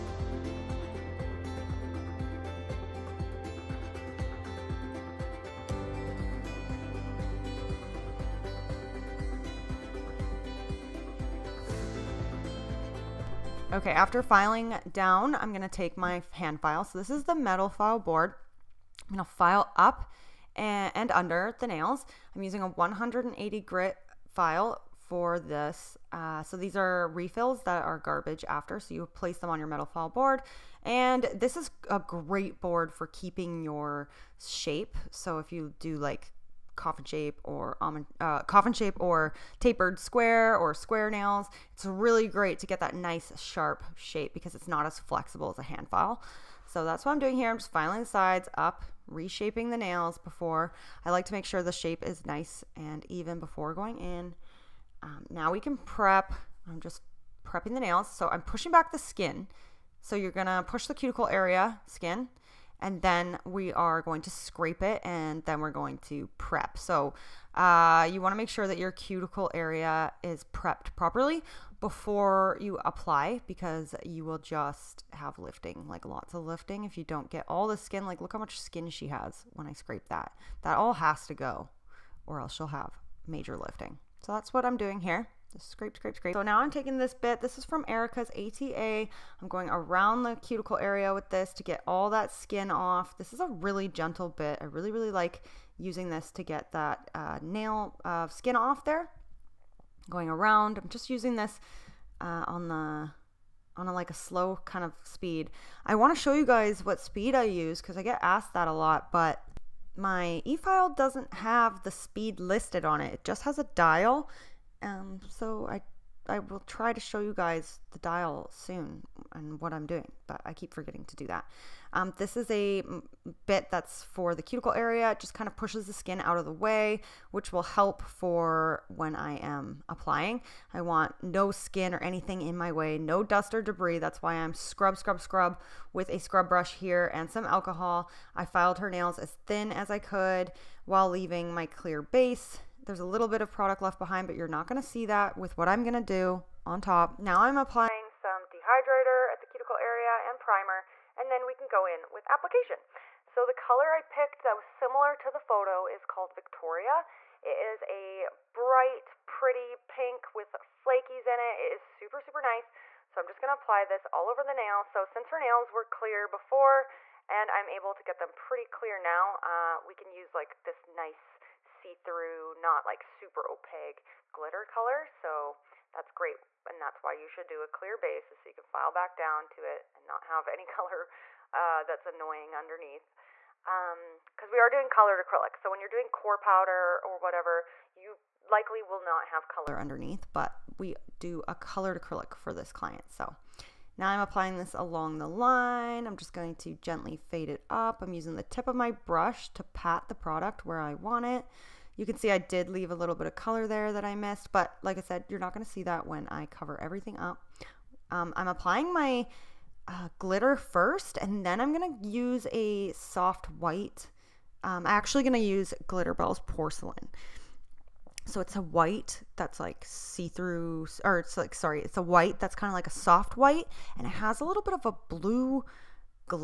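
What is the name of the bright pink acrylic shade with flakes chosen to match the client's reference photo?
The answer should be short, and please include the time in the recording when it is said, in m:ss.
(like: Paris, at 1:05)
Victoria, at 2:36.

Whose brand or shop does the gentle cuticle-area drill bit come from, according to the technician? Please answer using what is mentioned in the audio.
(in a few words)
Erica's ATA.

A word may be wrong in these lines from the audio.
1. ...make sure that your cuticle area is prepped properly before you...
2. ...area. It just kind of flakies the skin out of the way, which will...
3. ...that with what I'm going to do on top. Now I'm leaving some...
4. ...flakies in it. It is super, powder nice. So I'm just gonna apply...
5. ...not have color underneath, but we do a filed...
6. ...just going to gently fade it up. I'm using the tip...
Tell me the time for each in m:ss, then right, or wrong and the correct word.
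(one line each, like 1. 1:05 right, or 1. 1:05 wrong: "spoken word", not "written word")
1. 1:08 right
2. 2:04 wrong: "pushes", not "flakies"
3. 2:25 wrong: "applying", not "leaving"
4. 2:40 wrong: "super", not "powder"
5. 3:08 wrong: "colored", not "filed"
6. 3:16 right.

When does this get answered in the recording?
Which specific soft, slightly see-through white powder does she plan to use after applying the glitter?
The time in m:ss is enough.
3:35.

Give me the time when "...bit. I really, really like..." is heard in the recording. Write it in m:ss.
1:34.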